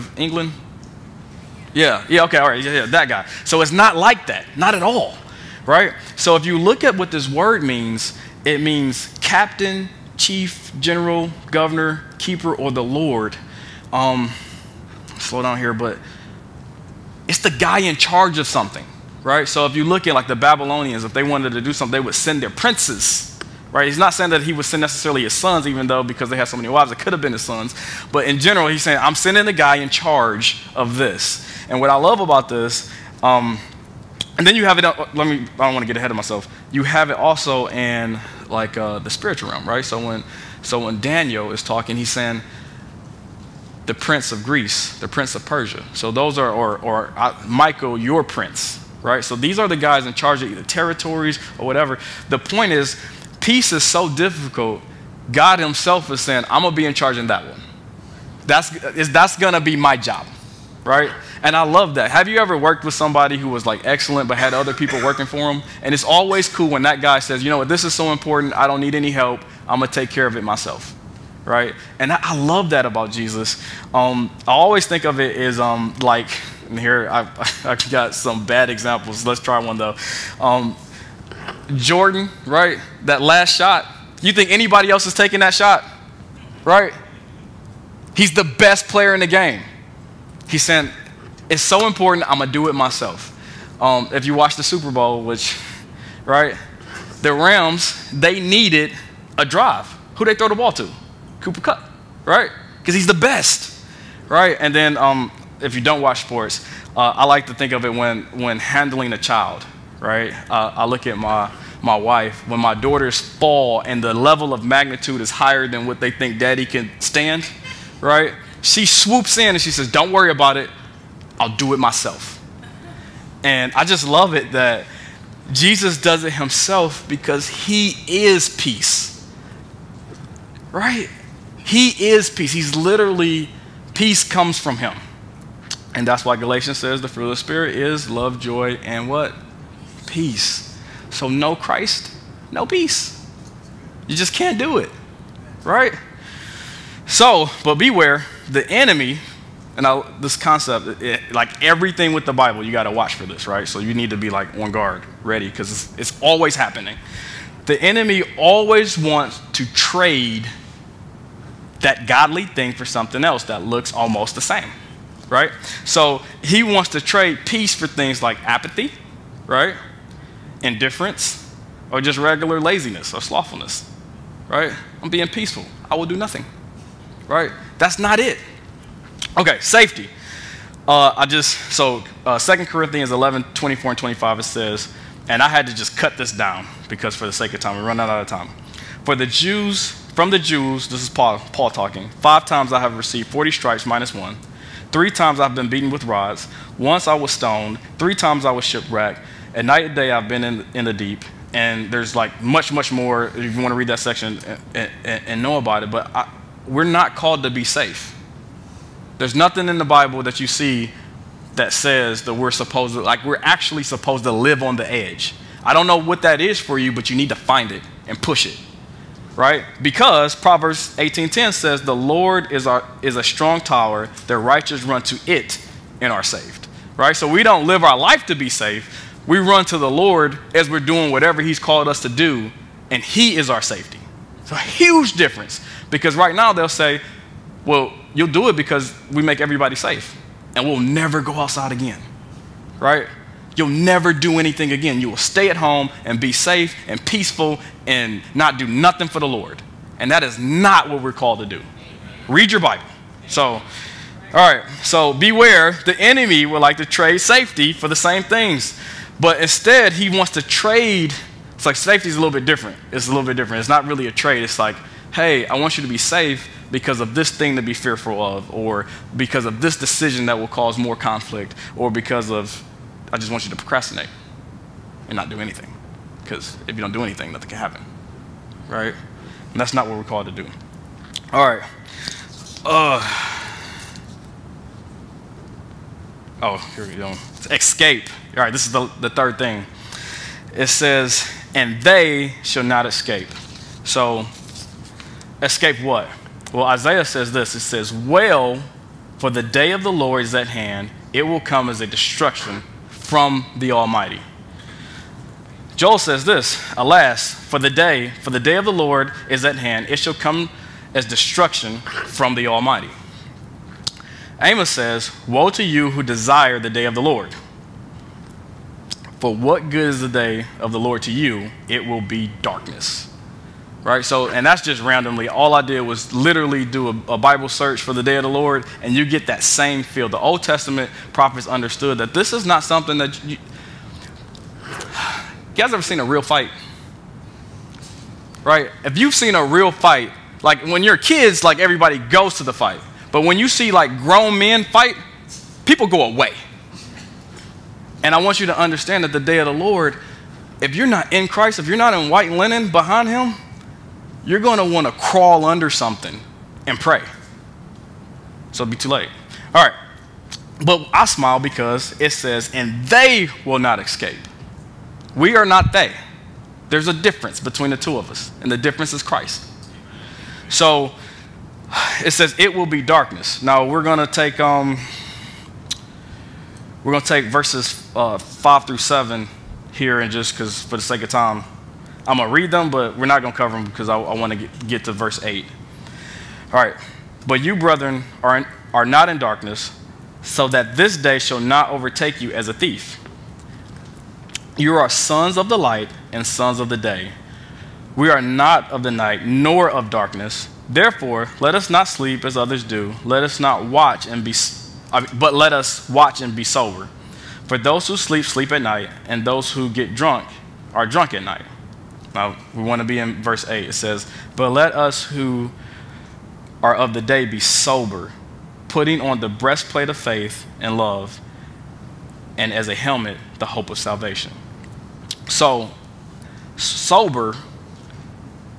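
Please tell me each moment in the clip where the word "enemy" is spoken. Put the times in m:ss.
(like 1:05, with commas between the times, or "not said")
2:28, 2:37, 4:15.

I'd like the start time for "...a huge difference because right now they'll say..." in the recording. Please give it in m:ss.
3:54.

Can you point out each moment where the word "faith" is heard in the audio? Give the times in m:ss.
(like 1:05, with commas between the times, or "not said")
6:59.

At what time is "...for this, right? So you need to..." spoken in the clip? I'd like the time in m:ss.
2:33.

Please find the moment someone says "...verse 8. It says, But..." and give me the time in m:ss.
6:53.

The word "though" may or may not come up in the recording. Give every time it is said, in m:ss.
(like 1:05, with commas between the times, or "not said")
0:25, 1:19.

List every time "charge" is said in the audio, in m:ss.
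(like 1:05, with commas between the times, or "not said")
0:17, 0:29, 0:50, 0:56.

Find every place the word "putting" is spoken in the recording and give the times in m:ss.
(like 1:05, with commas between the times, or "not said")
6:58.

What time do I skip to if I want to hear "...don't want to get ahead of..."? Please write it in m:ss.
0:35.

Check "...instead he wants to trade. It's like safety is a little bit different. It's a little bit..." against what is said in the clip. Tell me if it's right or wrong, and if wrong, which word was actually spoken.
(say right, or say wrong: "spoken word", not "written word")
right.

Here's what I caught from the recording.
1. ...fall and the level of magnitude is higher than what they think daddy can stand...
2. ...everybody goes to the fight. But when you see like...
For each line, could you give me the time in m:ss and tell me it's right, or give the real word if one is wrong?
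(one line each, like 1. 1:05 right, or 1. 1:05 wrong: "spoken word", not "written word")
1. 1:53 right
2. 5:41 right.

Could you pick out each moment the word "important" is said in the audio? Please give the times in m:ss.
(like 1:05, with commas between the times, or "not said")
1:08, 1:31.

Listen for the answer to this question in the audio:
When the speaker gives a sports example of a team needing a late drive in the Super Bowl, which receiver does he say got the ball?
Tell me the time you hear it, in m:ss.
1:41.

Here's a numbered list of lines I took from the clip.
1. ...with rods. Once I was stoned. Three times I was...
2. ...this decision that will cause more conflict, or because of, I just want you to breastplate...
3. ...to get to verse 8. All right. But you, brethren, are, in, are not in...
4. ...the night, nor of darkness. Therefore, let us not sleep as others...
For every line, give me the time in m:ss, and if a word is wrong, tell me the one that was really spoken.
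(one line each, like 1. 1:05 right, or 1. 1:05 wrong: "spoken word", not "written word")
1. 3:15 right
2. 4:29 wrong: "procrastinate", not "breastplate"
3. 6:24 right
4. 6:38 right.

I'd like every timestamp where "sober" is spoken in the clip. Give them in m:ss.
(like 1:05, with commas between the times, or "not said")
6:46, 6:57, 7:06.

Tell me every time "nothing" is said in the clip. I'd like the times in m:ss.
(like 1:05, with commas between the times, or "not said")
2:56, 3:29, 4:08, 4:37.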